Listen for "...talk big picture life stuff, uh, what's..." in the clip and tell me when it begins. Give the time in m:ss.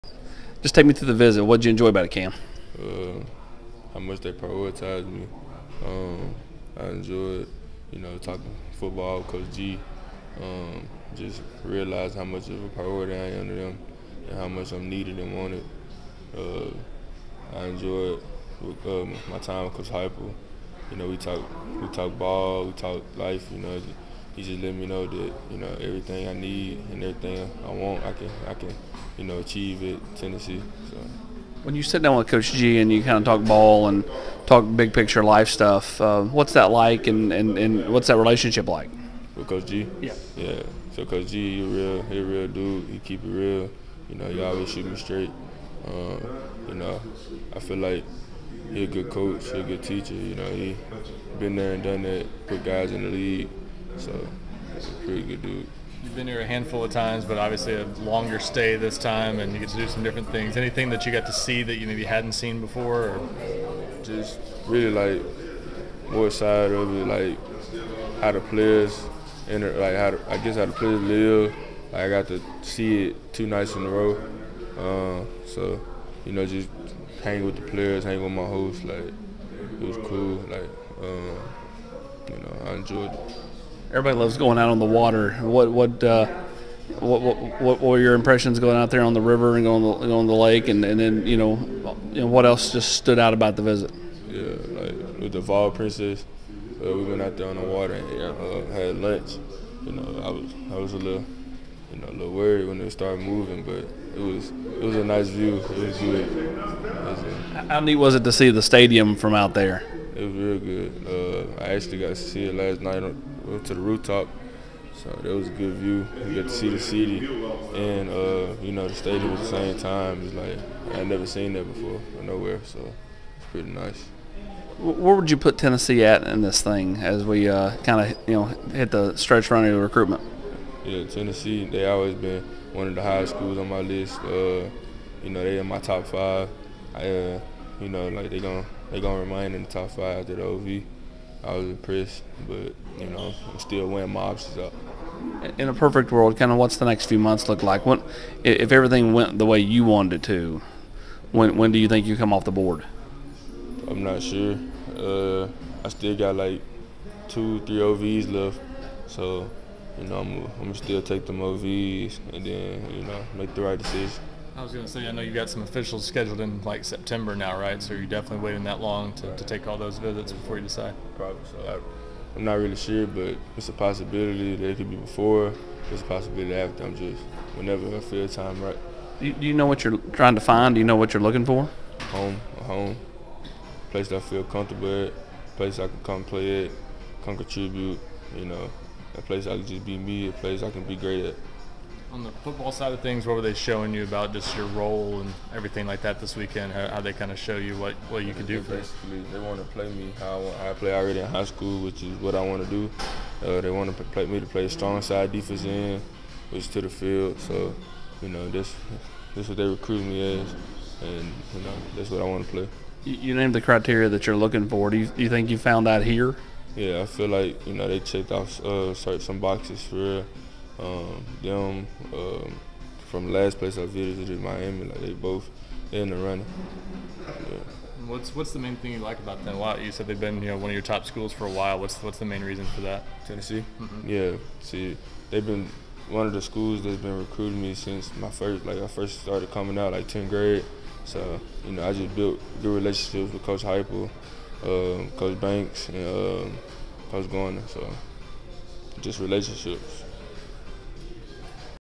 0:34.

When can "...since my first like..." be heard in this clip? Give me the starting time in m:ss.
3:57.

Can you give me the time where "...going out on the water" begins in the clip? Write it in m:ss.
1:24.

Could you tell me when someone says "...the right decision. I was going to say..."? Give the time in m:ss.
2:43.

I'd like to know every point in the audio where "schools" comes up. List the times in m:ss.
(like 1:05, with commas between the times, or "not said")
2:13, 3:21, 3:51, 3:56.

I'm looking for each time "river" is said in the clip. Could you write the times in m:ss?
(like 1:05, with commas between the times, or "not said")
1:29.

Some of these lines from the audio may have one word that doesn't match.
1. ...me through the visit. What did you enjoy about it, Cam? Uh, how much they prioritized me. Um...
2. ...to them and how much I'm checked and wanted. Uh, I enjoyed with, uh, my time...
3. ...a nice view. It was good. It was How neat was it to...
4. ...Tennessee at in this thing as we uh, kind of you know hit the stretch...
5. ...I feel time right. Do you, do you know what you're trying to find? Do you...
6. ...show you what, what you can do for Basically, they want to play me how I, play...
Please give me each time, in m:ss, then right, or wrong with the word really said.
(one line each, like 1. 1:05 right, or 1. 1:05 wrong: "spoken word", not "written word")
1. 0:00 right
2. 0:13 wrong: "needed", not "checked"
3. 1:44 right
4. 2:05 right
5. 2:57 right
6. 3:17 right.